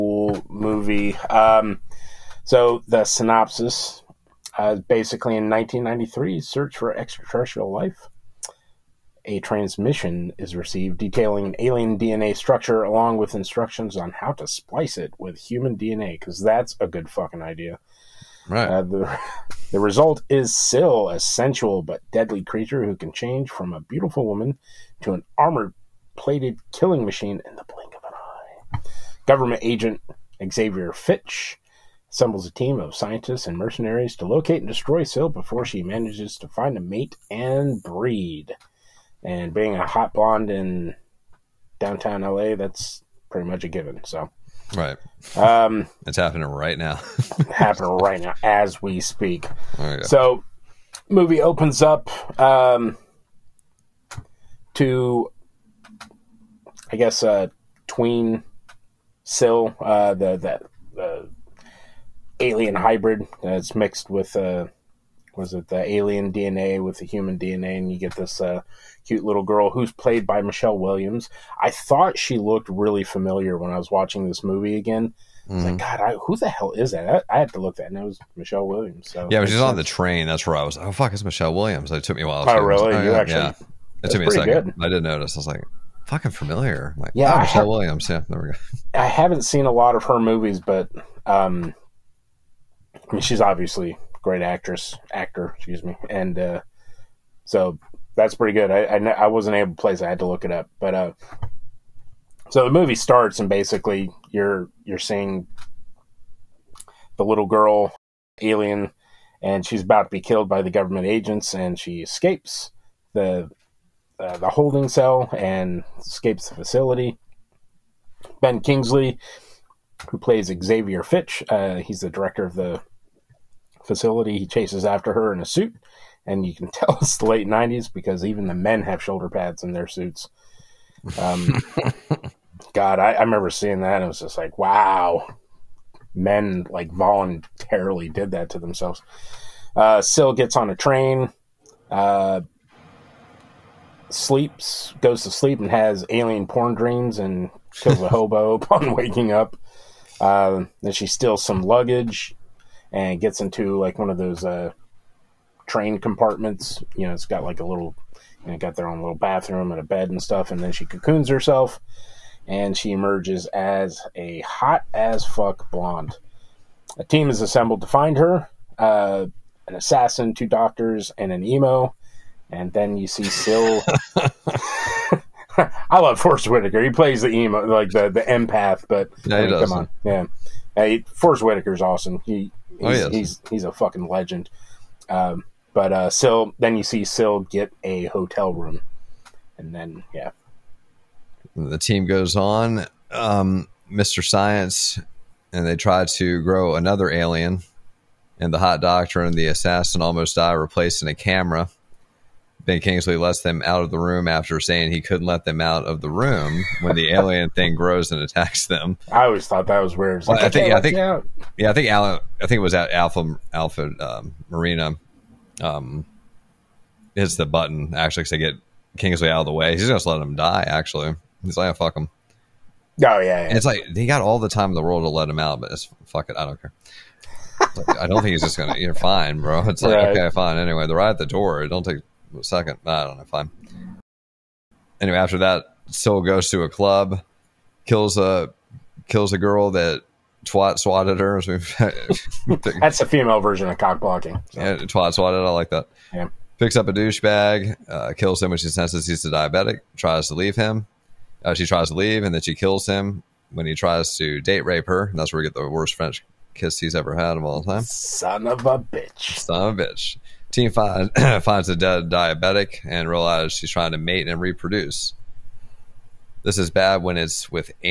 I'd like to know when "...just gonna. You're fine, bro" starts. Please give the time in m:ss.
3:48.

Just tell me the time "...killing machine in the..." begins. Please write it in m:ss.
0:26.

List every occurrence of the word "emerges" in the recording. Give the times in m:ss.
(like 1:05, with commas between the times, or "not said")
2:42.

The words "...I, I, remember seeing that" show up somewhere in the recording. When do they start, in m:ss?
2:12.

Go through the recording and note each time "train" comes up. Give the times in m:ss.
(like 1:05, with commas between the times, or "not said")
1:19, 2:20, 2:35.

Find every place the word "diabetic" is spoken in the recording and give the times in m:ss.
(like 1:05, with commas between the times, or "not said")
4:09, 4:22.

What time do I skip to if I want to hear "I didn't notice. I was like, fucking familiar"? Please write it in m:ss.
1:24.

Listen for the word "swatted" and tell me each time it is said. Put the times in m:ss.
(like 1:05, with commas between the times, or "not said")
4:00, 4:05.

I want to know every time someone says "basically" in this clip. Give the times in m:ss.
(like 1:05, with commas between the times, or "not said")
0:04, 1:43.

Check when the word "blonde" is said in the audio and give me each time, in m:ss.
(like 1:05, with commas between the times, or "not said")
0:40, 2:45.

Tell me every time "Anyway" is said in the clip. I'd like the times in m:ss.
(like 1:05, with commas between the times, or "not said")
3:50, 3:55.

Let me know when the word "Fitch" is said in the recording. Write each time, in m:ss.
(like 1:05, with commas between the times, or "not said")
0:30, 2:01.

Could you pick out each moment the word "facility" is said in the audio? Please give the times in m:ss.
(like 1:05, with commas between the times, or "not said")
1:56, 2:03.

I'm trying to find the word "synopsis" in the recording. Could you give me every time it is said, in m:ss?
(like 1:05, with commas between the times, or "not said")
0:03.